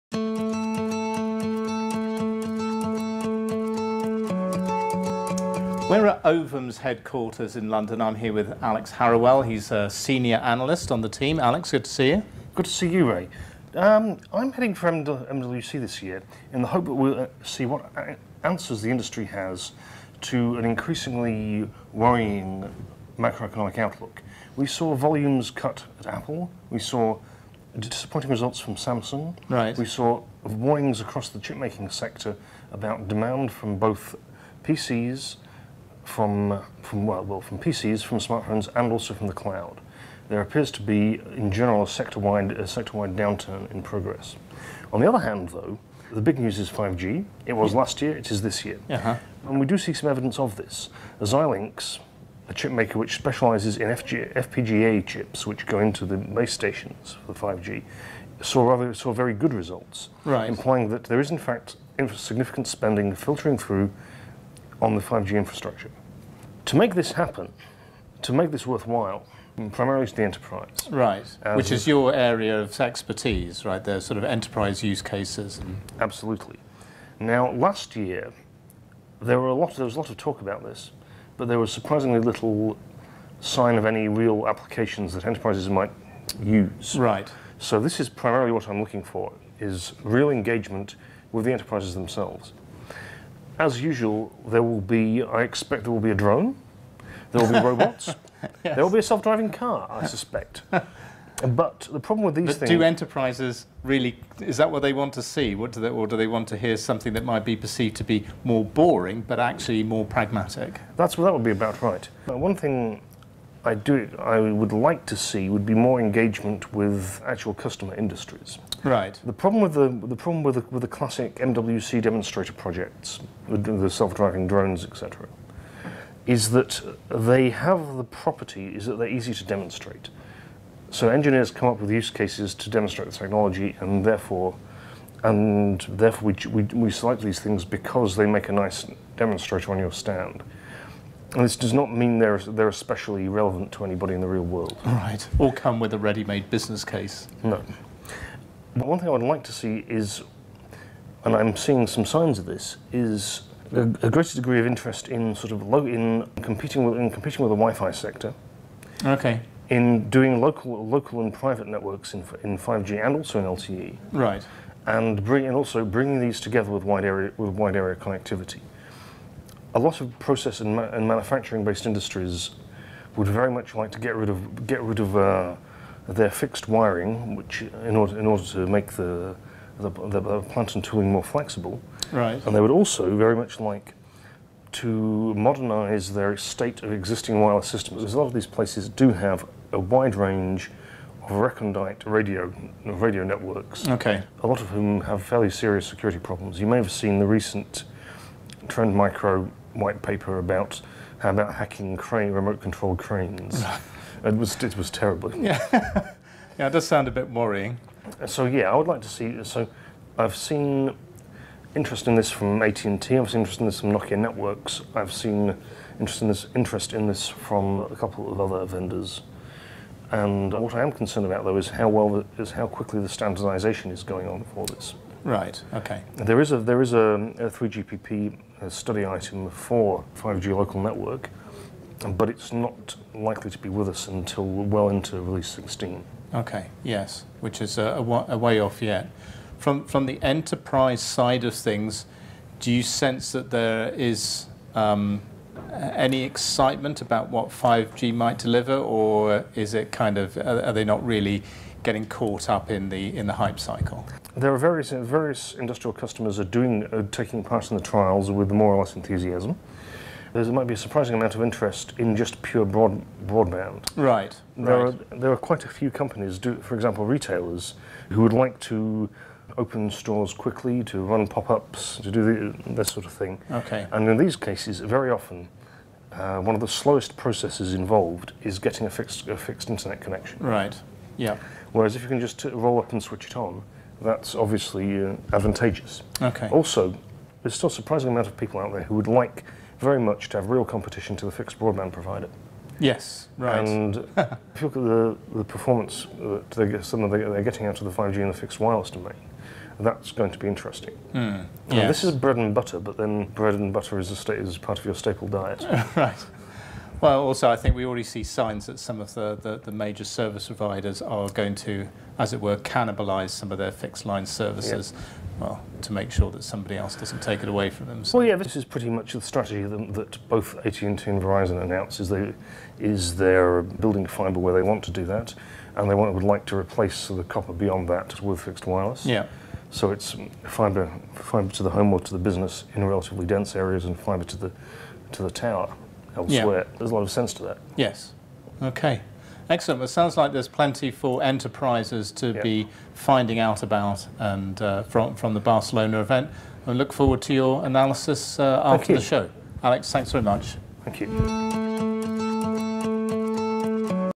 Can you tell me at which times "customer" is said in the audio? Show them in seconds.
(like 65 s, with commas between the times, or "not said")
117 s, 255 s.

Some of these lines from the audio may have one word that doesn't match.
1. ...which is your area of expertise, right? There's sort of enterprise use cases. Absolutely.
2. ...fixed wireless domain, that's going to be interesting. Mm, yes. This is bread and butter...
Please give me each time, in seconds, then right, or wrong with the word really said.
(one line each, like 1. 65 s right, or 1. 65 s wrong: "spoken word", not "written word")
1. 71 s right
2. 298 s right.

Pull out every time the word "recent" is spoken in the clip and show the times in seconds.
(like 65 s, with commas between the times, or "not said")
197 s.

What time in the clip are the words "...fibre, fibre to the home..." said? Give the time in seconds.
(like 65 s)
330 s.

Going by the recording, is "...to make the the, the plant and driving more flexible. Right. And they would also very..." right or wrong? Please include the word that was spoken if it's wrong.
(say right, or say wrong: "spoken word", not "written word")
wrong: "tooling", not "driving".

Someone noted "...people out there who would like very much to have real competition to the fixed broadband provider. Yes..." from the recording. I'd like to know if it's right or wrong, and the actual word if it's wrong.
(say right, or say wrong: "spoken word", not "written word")
right.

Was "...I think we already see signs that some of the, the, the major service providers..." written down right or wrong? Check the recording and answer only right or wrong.
right.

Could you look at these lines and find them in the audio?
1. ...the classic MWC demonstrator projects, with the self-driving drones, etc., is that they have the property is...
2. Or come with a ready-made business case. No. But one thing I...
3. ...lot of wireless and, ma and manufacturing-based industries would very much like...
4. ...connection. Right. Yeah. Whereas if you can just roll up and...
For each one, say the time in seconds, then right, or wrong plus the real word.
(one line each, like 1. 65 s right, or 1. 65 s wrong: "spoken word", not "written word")
1. 120 s right
2. 145 s right
3. 169 s wrong: "process", not "wireless"
4. 279 s right.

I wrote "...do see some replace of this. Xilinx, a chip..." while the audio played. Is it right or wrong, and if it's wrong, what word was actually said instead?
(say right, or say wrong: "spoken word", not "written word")
wrong: "evidence", not "replace".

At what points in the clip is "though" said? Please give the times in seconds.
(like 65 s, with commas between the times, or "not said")
45 s, 221 s.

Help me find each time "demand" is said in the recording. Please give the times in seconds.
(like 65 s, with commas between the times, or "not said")
33 s.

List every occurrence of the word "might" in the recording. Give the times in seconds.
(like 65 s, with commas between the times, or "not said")
85 s, 107 s, 248 s, 260 s.